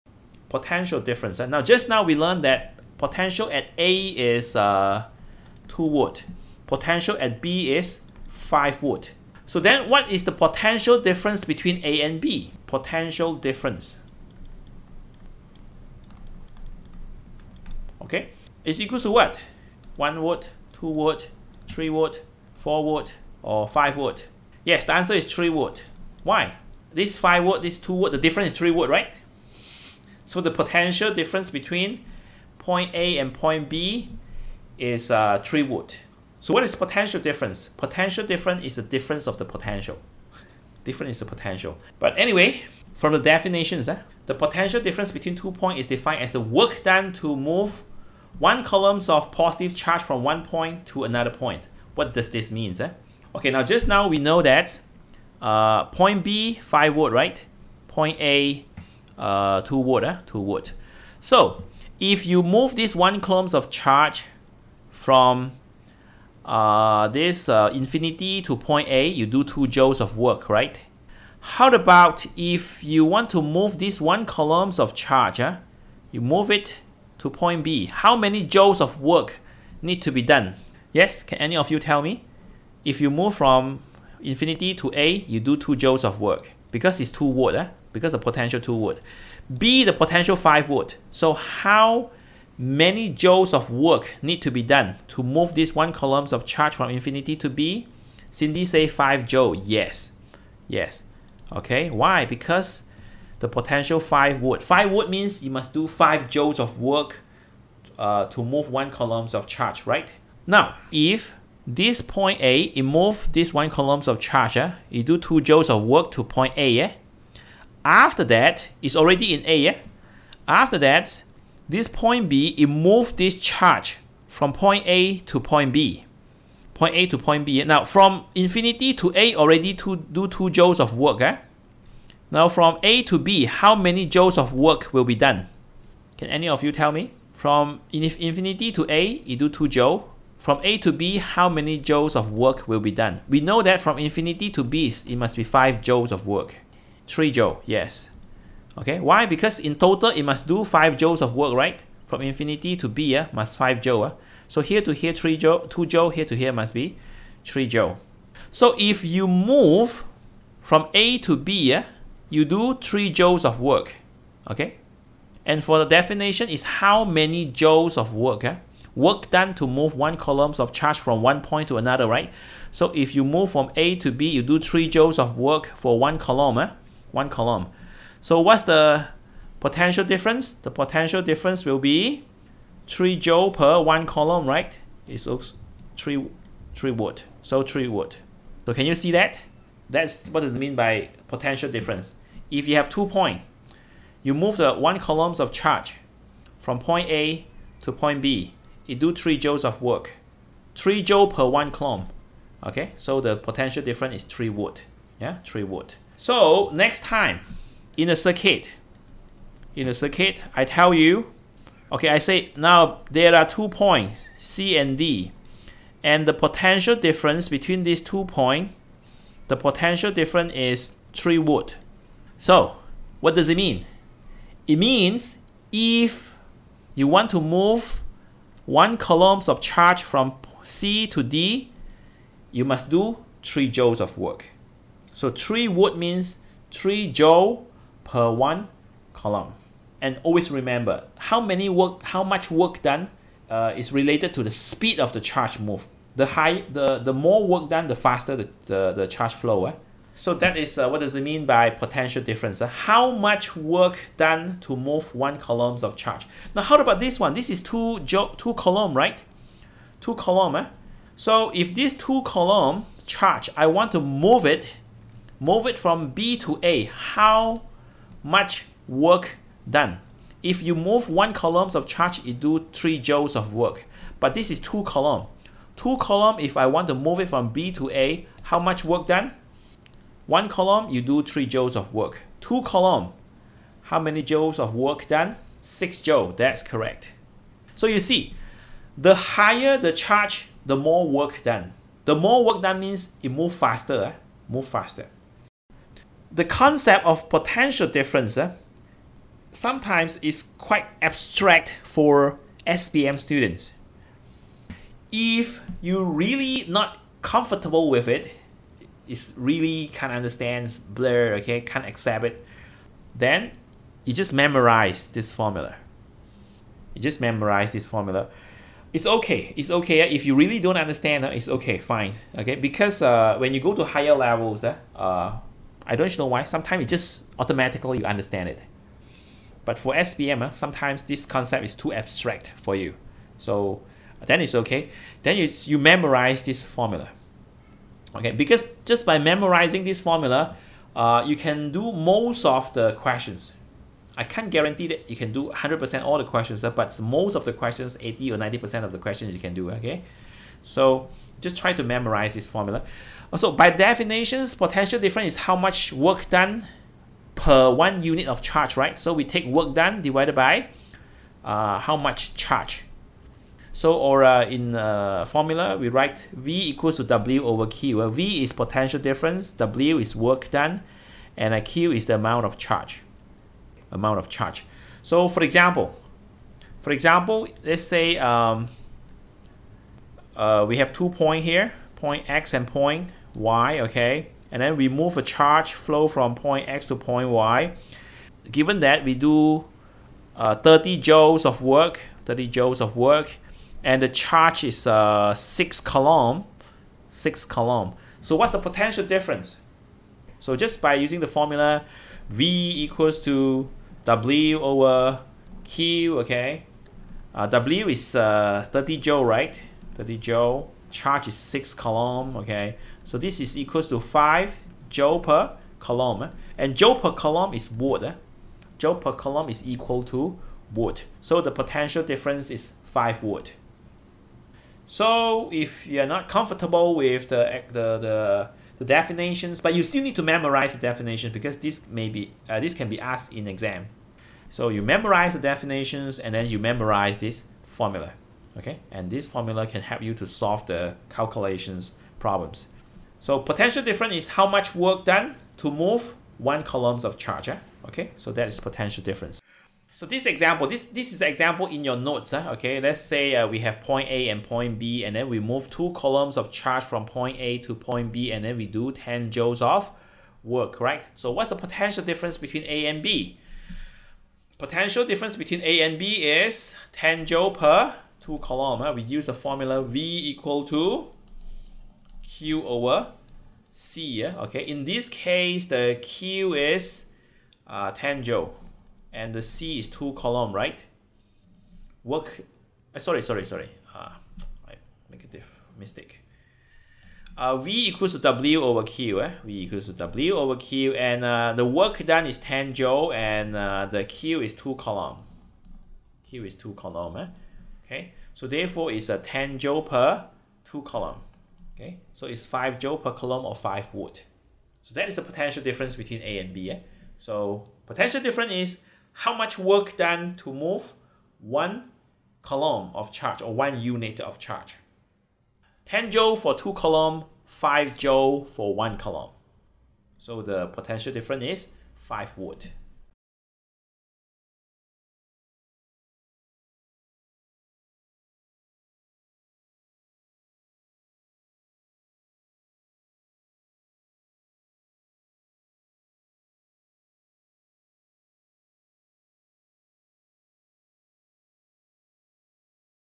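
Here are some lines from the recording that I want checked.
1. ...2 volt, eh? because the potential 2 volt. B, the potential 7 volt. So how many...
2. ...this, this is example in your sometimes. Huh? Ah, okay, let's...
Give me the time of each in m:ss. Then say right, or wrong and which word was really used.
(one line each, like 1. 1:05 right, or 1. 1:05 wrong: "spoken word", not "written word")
1. 1:27 wrong: "5", not "7"
2. 7:30 wrong: "notes", not "sometimes".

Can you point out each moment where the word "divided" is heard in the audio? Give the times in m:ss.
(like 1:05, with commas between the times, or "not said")
6:00.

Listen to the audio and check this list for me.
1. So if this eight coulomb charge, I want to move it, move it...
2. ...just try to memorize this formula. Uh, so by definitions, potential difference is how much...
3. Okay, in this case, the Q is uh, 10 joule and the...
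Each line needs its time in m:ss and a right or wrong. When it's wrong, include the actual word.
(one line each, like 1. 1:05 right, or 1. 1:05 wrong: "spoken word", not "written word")
1. 4:21 wrong: "two", not "eight"
2. 5:51 right
3. 7:54 right.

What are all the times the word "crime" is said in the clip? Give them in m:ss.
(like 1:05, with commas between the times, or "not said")
not said.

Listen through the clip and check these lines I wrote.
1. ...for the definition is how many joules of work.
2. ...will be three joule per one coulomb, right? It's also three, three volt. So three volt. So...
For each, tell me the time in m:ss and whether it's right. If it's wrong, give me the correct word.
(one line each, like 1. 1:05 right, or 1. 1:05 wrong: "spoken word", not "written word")
1. 2:45 right
2. 3:01 right.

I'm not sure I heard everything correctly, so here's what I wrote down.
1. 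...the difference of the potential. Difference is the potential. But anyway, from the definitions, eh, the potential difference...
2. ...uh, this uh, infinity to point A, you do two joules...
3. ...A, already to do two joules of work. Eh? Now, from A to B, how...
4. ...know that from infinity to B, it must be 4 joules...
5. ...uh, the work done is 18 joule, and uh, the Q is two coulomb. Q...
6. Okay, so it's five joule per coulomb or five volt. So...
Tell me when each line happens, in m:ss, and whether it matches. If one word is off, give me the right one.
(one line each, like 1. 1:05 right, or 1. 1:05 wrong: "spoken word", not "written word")
1. 0:38 right
2. 1:06 right
3. 2:09 right
4. 2:23 wrong: "5", not "4"
5. 8:11 wrong: "10", not "18"
6. 8:21 right.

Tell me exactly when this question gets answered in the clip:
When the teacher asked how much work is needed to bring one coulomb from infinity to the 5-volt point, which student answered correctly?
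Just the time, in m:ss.
1:38.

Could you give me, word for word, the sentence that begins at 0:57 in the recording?
Point A, uh, two volt, eh?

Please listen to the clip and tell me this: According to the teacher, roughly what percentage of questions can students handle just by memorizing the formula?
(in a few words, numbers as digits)
80 or 90%.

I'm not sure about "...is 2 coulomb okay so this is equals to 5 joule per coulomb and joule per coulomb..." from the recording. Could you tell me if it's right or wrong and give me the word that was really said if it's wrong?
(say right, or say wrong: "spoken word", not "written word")
wrong: "6", not "2".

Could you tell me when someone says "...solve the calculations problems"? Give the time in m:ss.
7:20.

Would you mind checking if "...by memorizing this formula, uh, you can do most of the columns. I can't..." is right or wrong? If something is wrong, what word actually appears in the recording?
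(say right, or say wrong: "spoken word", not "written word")
wrong: "questions", not "columns".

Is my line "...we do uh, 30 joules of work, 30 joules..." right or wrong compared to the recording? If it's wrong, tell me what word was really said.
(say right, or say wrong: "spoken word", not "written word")
right.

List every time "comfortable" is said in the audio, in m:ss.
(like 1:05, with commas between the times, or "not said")
5:07, 7:06.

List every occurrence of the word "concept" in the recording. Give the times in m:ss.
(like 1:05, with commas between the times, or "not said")
4:56, 5:31.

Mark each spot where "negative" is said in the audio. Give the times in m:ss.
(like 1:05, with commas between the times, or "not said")
not said.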